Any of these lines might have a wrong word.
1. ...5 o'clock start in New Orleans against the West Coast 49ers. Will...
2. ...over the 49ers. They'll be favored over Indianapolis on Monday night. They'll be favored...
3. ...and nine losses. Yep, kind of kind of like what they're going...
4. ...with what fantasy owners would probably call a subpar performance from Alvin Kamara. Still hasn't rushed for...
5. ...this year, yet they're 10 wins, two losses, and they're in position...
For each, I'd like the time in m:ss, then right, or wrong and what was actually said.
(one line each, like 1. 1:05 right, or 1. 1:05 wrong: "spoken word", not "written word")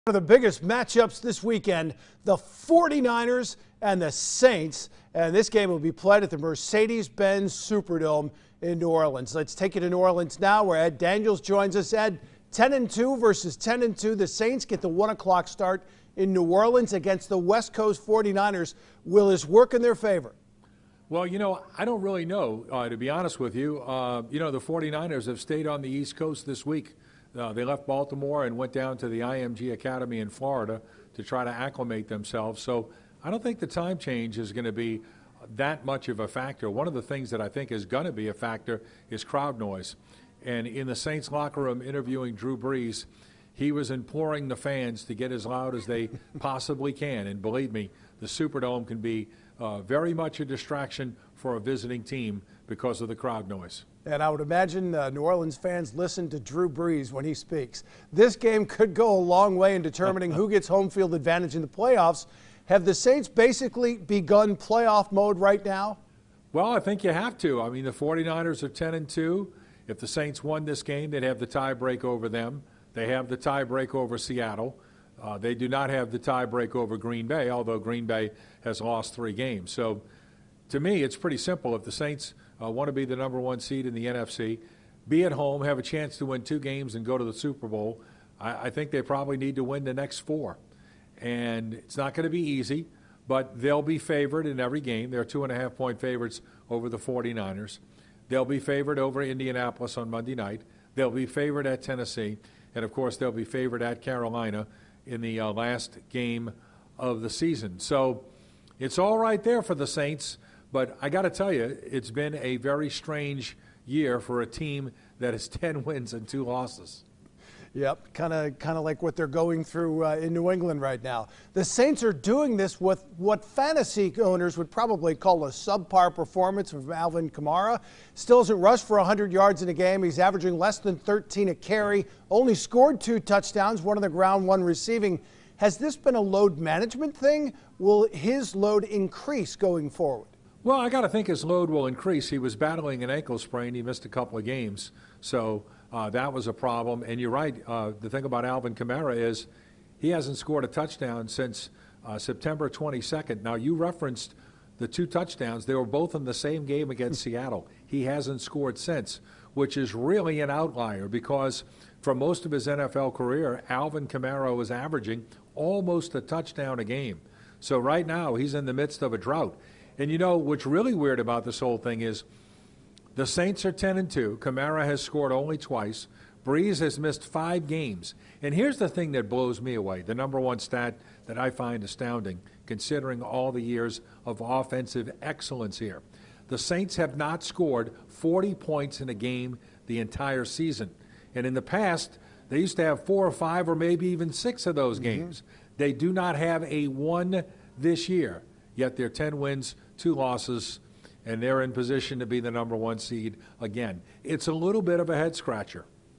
1. 0:14 wrong: "1", not "5"
2. 1:36 right
3. 1:56 wrong: "two", not "nine"
4. 2:02 right
5. 3:17 right.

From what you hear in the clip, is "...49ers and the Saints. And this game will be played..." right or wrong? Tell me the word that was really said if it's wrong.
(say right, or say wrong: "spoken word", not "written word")
right.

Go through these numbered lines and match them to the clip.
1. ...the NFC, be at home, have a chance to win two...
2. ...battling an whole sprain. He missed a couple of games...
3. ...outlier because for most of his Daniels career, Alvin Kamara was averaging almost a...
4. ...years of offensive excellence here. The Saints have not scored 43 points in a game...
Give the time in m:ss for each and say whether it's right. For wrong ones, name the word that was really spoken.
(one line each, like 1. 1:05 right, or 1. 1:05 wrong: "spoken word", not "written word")
1. 1:23 right
2. 2:22 wrong: "ankle", not "whole"
3. 2:40 wrong: "NFL", not "Daniels"
4. 3:03 wrong: "40", not "43".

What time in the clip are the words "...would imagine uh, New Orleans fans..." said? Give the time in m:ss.
0:54.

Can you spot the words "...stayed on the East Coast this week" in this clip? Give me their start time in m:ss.
0:25.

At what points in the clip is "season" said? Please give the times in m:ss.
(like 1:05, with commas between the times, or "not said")
1:47, 3:10.